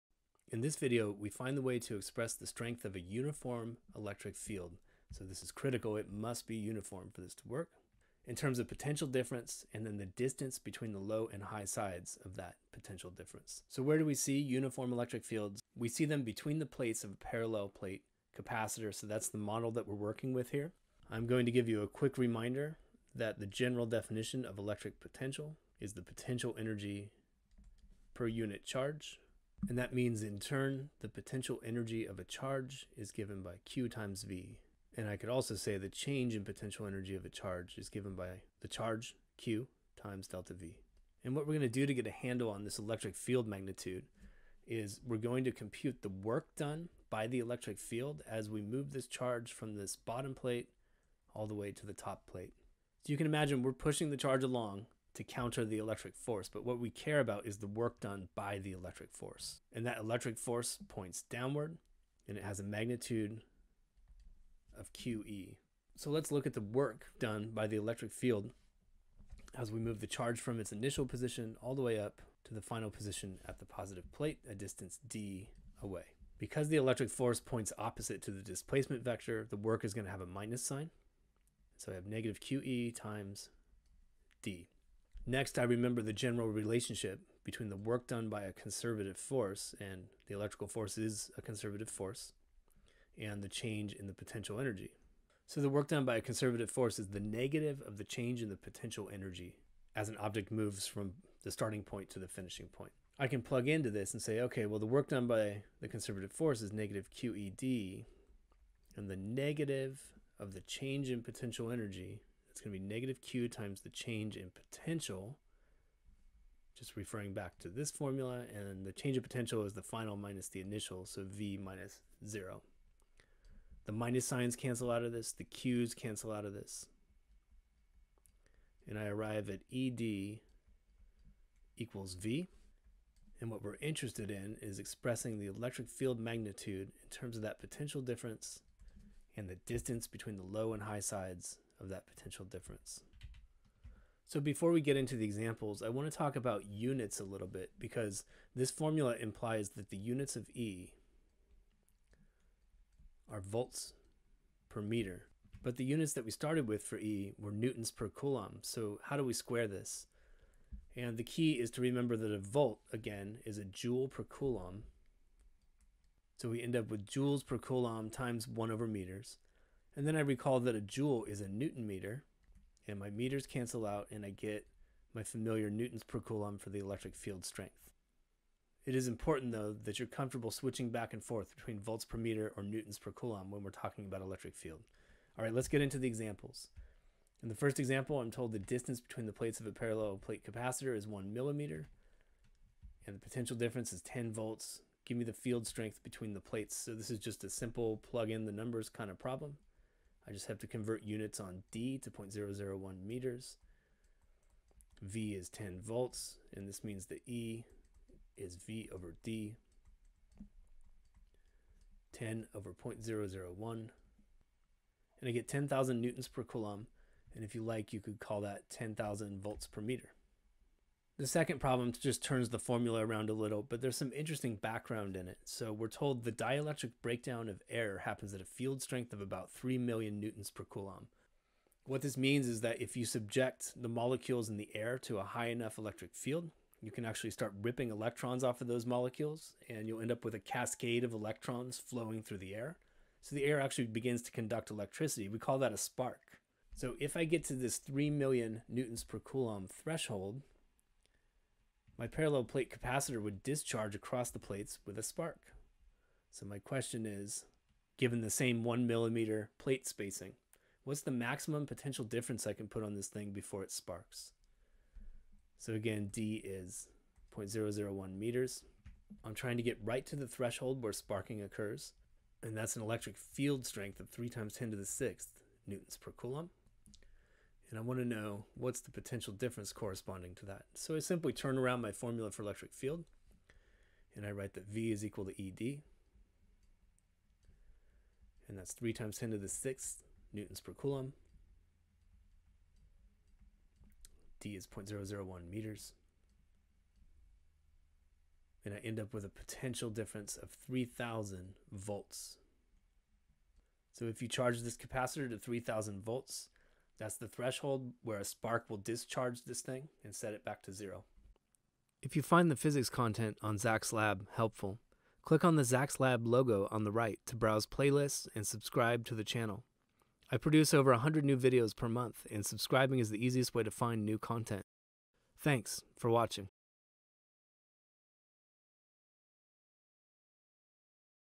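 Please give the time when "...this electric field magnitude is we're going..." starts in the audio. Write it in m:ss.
0:42.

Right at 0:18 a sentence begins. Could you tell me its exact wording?
So that's the model that we're working with here.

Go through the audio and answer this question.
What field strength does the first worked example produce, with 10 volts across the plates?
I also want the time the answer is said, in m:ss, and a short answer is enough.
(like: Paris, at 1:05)
10,000 newtons per coulomb, at 3:35.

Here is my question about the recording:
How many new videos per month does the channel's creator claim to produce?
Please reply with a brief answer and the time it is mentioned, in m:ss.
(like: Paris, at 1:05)
over 100, at 5:20.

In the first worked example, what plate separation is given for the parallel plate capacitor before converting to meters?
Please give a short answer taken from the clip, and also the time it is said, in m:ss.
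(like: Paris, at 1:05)
1 millimeter, at 3:11.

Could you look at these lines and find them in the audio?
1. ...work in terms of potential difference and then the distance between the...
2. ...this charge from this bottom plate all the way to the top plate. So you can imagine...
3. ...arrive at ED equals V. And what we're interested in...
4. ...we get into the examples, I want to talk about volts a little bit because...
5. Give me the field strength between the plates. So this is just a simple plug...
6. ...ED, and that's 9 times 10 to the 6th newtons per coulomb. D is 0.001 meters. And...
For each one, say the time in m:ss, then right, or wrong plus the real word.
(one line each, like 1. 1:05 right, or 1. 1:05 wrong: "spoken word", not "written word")
1. 0:07 right
2. 0:48 right
3. 2:09 right
4. 2:24 wrong: "units", not "volts"
5. 3:15 right
6. 4:45 wrong: "3", not "9".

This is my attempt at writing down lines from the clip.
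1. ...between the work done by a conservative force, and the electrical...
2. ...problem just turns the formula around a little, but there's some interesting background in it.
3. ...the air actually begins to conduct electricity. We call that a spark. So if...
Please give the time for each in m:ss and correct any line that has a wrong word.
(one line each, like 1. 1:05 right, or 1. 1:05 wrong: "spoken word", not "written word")
1. 1:27 right
2. 3:41 right
3. 4:03 right.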